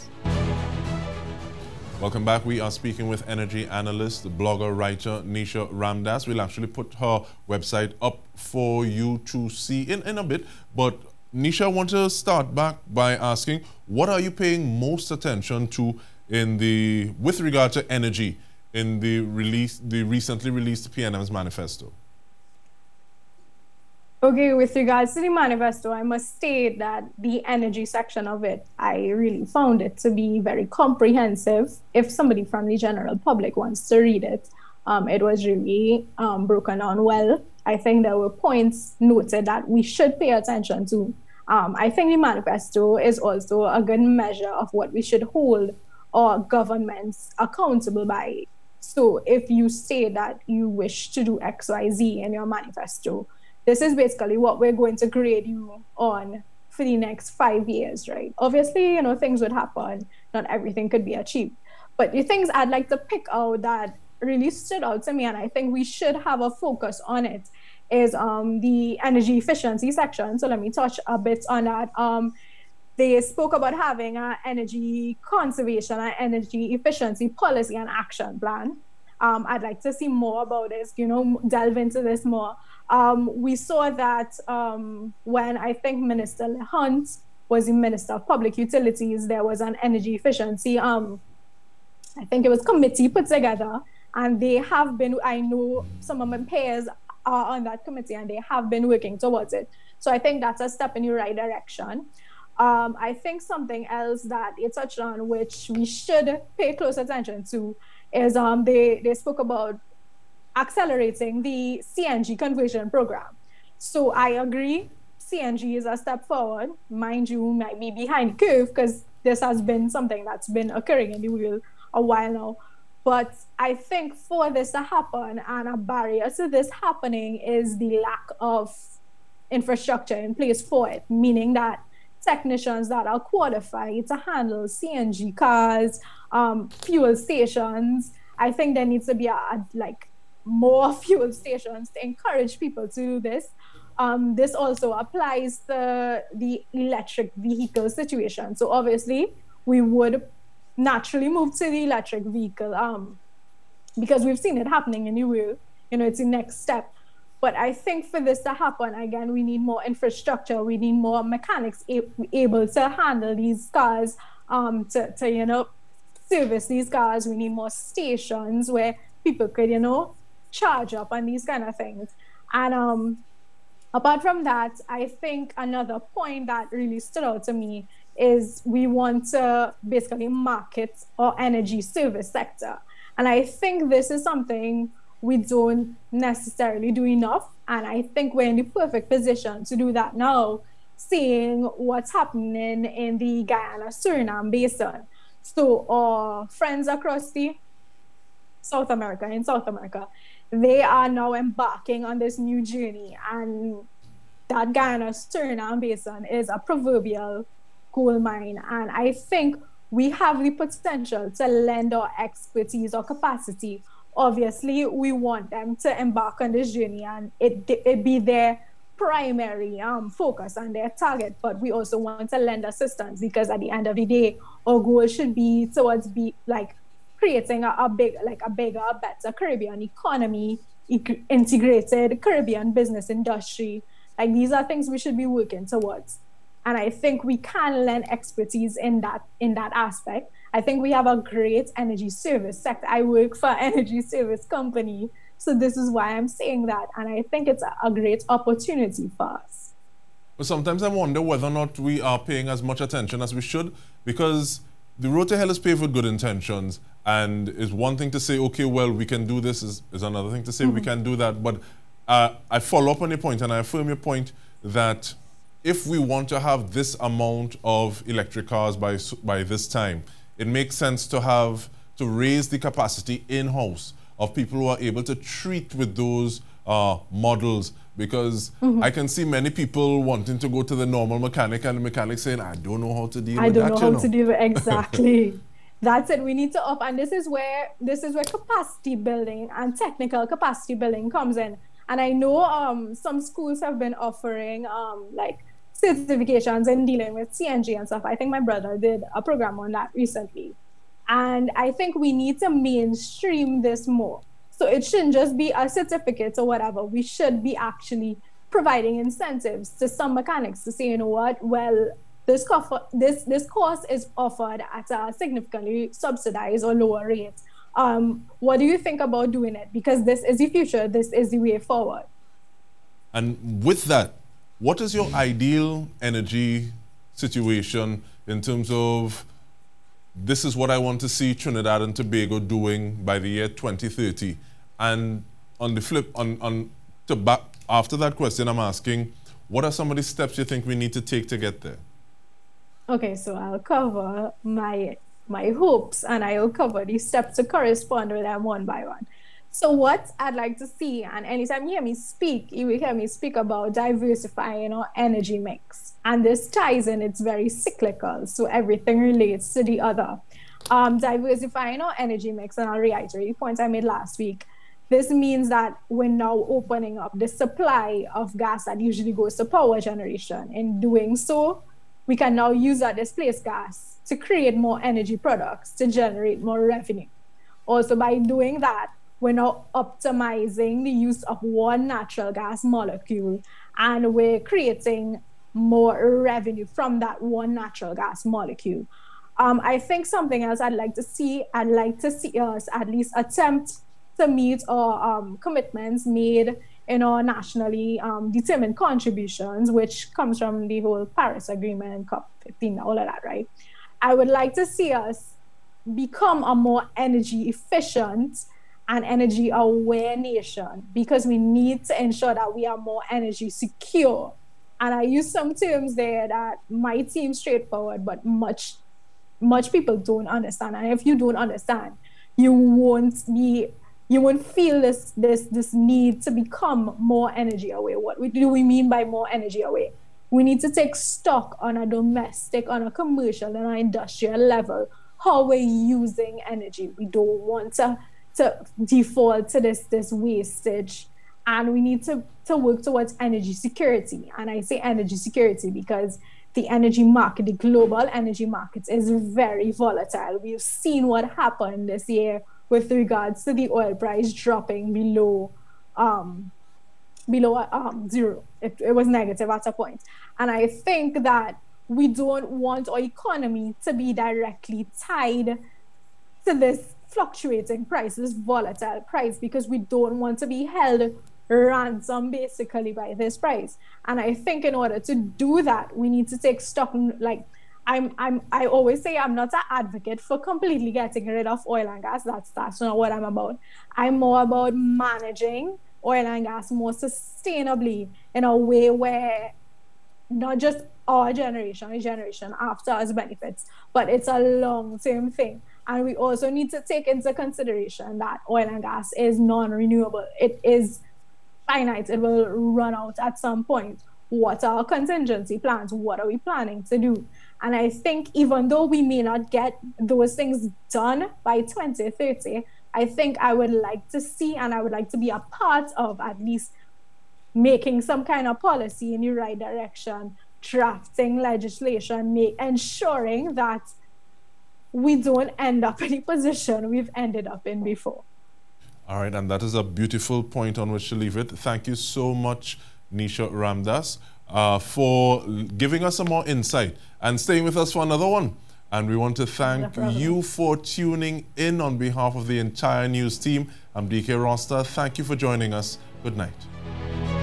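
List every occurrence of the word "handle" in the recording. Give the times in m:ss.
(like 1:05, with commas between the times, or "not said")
2:14, 2:42.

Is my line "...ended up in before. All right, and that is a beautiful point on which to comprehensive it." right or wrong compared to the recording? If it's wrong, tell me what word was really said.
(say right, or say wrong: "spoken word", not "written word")
wrong: "leave", not "comprehensive".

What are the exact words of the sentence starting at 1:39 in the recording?
So I think that's a step in the right direction.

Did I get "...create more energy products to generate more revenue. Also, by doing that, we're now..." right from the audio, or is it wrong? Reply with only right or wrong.
right.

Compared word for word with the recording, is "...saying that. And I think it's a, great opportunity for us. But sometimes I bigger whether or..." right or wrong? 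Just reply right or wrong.
wrong.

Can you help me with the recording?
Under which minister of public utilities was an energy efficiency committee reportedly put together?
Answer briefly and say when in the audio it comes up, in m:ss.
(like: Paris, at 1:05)
Minister Hunte, at 1:26.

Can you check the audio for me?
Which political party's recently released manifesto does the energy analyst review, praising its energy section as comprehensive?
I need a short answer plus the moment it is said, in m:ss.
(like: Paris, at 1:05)
PNM, at 0:20.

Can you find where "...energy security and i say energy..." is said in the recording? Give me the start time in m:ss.
7:23.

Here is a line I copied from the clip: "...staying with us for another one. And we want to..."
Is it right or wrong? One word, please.
right.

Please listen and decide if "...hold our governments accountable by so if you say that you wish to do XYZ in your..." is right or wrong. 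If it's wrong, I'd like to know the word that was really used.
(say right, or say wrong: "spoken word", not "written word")
right.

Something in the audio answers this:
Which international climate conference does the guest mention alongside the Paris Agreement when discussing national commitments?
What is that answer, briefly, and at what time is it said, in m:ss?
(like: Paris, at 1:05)
COP15, at 6:42.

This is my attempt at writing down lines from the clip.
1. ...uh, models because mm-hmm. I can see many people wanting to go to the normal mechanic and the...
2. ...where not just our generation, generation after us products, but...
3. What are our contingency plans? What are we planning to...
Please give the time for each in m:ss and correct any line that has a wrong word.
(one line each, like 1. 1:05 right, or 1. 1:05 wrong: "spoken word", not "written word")
1. 4:36 right
2. 8:08 wrong: "benefits", not "products"
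3. 8:24 right.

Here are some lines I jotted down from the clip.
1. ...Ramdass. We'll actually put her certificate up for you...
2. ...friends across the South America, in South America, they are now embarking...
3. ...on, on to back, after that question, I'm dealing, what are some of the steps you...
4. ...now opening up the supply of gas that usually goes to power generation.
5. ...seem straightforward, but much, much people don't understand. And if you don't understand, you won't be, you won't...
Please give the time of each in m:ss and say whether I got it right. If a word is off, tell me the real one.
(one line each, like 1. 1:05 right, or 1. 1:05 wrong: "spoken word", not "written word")
1. 0:05 wrong: "website", not "certificate"
2. 3:16 right
3. 5:36 wrong: "asking", not "dealing"
4. 6:06 right
5. 6:57 right.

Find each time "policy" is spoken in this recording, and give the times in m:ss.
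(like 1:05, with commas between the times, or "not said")
1:17, 8:38.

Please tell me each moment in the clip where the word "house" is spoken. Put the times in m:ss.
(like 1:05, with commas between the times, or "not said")
4:33.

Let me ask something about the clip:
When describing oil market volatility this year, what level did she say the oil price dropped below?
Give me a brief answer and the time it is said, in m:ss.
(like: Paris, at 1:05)
Zero, at 7:38.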